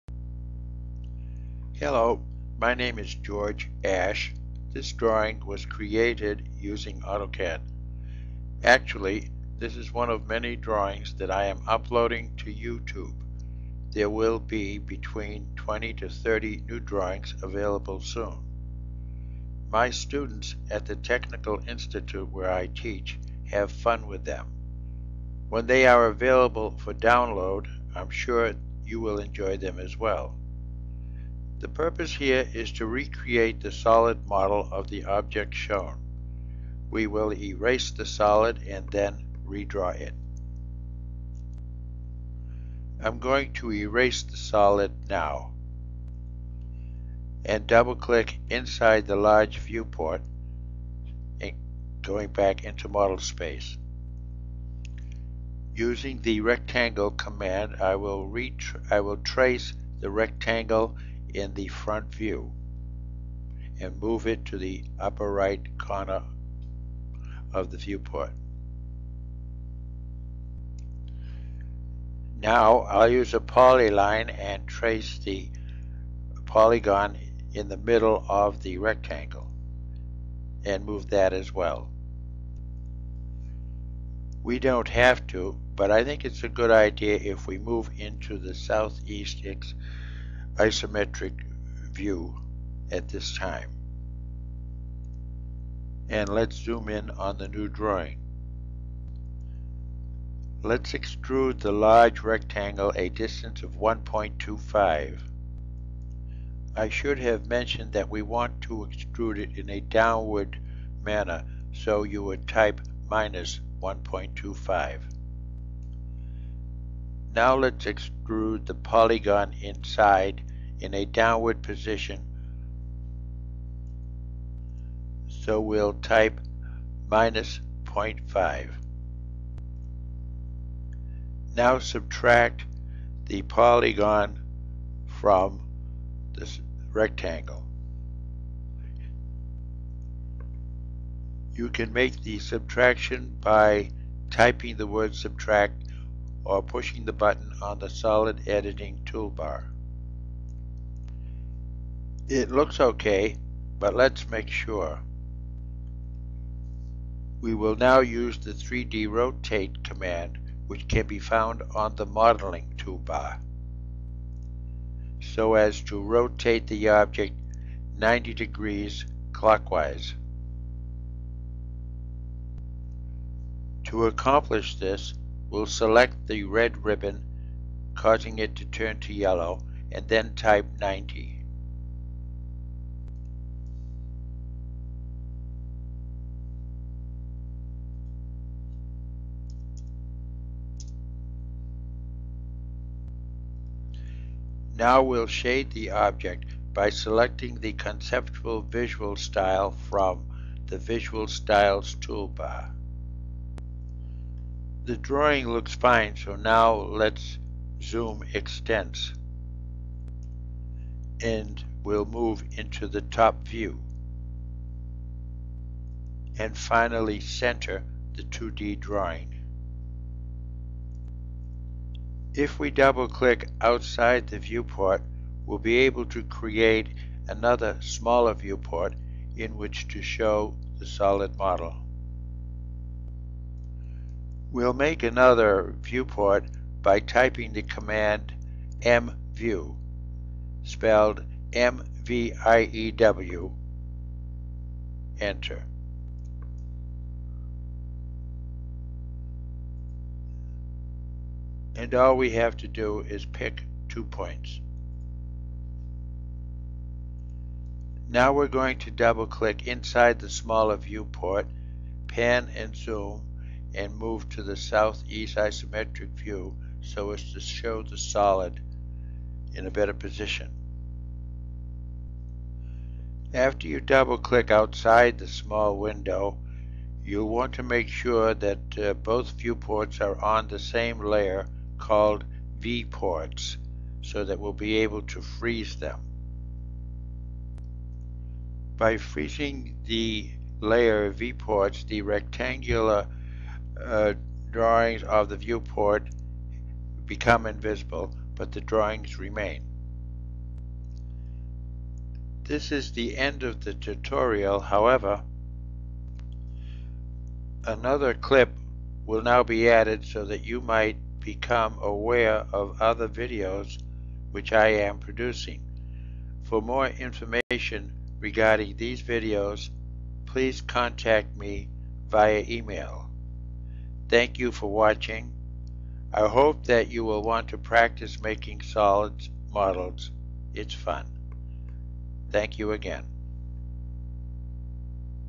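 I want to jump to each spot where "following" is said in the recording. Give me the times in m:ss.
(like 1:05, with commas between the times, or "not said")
not said.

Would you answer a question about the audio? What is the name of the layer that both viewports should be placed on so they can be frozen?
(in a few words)
V-ports.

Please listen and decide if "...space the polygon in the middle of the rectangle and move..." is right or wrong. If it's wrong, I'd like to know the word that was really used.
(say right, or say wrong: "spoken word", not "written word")
wrong: "trace", not "space".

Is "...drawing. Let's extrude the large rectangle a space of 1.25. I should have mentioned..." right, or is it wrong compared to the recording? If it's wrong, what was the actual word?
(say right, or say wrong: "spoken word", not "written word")
wrong: "distance", not "space".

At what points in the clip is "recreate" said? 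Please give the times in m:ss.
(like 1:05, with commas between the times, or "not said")
0:32.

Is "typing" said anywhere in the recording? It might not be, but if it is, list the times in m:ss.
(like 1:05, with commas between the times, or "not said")
2:24, 3:57.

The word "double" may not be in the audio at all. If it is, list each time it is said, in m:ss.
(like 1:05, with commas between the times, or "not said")
0:47, 3:42, 4:18, 4:33.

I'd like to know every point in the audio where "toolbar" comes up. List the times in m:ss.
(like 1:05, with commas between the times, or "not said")
2:29, 2:42, 3:22.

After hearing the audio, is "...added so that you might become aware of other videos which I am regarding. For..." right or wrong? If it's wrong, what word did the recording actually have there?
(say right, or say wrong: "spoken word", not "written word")
wrong: "producing", not "regarding".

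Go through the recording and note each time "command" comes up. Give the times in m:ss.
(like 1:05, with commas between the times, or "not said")
0:57, 2:39, 3:57.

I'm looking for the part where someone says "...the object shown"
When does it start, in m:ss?
0:34.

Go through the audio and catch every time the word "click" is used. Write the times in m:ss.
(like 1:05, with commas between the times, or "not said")
0:47, 3:43, 4:19, 4:34.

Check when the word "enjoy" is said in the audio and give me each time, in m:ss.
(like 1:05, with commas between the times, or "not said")
0:29.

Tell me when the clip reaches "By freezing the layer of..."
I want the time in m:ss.
4:48.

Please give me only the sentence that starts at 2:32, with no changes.
It looks okay, but let's make sure.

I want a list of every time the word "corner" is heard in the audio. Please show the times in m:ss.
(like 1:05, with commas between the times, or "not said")
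1:05.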